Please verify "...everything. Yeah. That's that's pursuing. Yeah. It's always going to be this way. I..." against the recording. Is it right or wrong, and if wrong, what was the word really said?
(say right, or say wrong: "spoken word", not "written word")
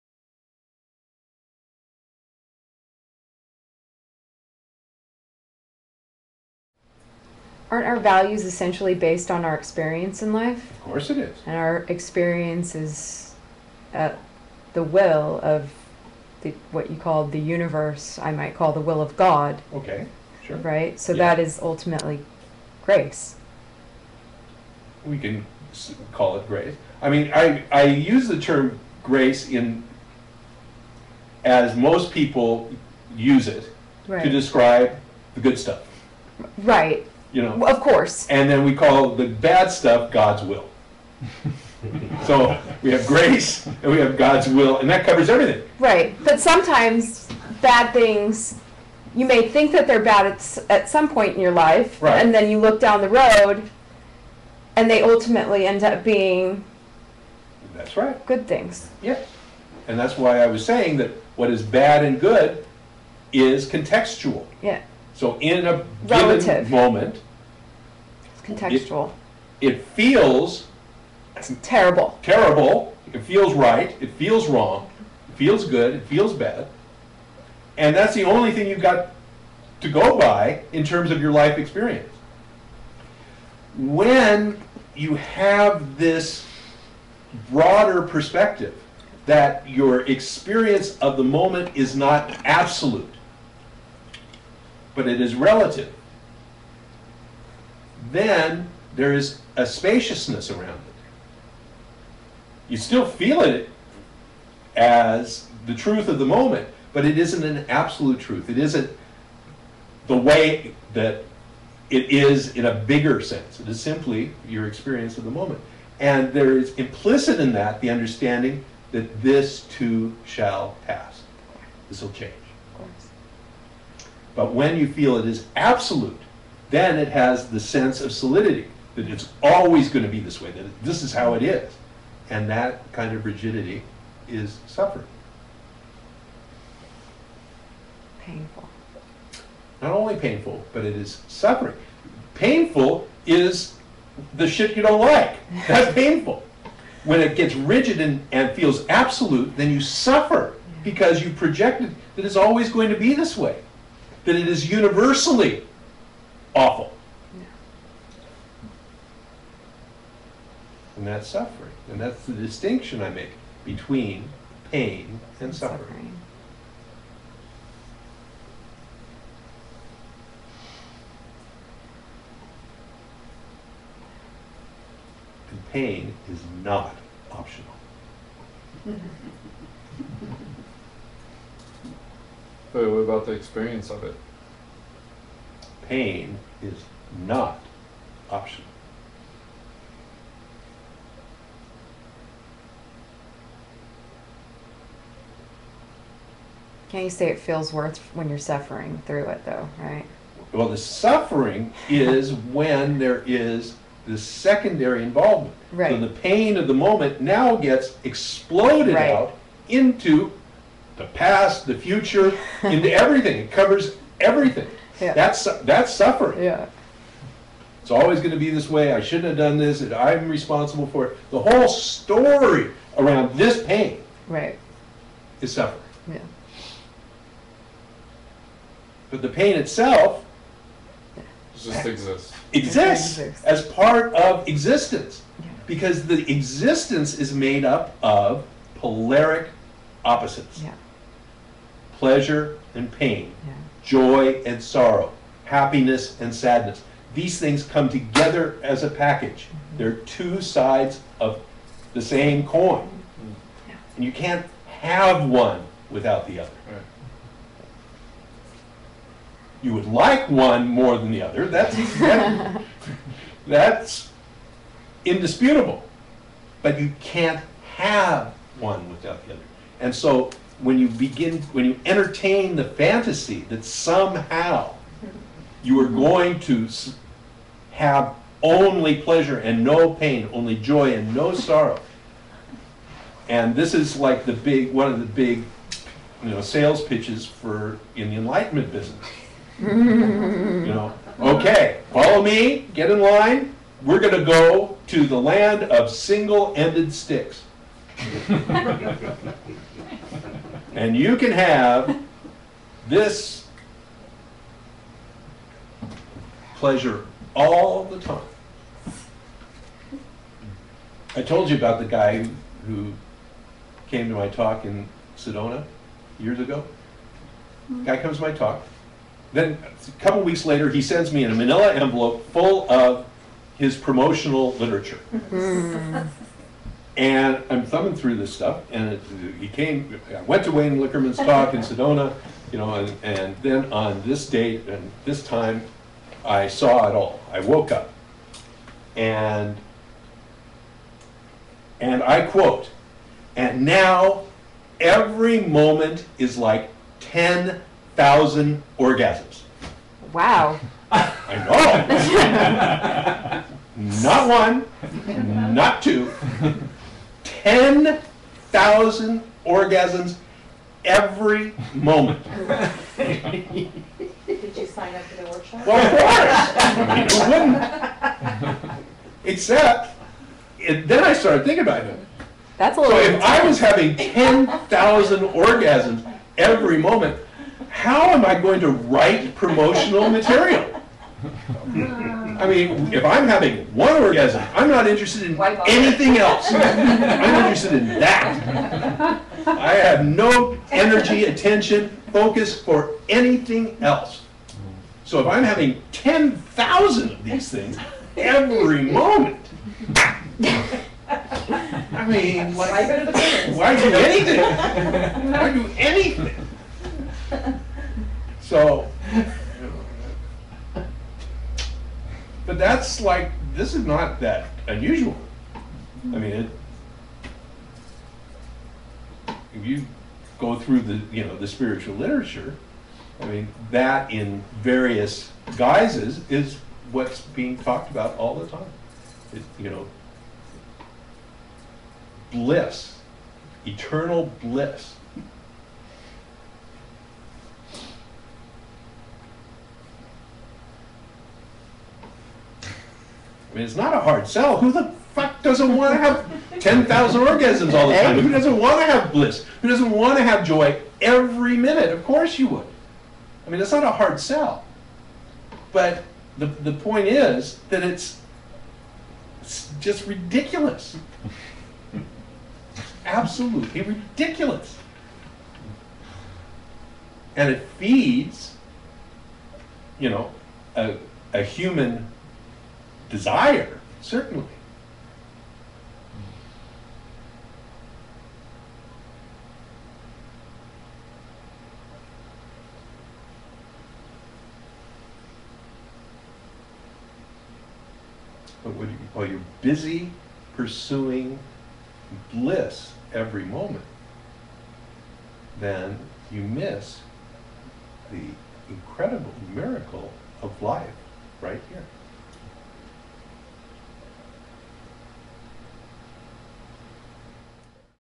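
wrong: "suffering", not "pursuing".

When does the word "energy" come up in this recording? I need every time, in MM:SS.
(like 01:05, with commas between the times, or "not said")
06:30.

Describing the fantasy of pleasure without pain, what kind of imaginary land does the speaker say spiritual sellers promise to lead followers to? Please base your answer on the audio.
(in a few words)
the land of single-ended sticks.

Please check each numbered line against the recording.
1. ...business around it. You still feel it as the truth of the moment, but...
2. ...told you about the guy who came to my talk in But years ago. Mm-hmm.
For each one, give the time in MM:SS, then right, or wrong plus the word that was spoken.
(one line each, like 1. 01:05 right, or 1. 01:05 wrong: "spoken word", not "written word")
1. 01:39 wrong: "spaciousness", not "business"
2. 05:11 wrong: "Sedona", not "But".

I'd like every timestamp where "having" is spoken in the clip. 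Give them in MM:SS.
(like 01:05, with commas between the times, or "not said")
06:13, 06:23, 06:35.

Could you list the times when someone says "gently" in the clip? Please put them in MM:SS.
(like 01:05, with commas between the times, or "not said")
not said.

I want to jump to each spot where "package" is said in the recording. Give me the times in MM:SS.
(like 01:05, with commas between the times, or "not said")
04:08.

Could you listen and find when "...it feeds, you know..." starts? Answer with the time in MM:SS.
07:47.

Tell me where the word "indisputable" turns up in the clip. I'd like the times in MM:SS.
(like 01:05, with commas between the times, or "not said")
04:25.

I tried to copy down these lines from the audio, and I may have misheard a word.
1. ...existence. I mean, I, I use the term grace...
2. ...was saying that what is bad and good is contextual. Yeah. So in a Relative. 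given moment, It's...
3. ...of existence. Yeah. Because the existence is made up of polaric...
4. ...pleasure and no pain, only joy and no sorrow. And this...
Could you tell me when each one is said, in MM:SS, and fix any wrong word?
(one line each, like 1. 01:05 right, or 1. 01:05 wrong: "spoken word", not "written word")
1. 00:26 wrong: "grace", not "existence"
2. 01:00 right
3. 03:54 right
4. 04:39 right.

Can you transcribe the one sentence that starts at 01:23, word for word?
When you have this broader perspective that your experience of the moment is not absolute, but it is relative.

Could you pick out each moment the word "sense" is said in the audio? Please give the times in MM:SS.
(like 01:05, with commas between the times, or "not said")
01:53, 02:07.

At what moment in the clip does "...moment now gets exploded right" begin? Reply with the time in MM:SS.
03:26.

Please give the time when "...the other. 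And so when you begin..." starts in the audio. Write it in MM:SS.
04:29.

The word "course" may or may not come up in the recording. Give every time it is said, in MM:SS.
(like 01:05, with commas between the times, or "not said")
00:10, 00:37, 06:07, 07:32.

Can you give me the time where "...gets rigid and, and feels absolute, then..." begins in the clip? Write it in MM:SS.
02:27.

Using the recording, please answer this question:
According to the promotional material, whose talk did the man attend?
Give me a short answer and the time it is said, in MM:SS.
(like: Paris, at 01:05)
Wayne Liquorman, at 05:30.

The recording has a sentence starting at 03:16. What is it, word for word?
Can't you say it feels worth when you're suffering through it, though, right?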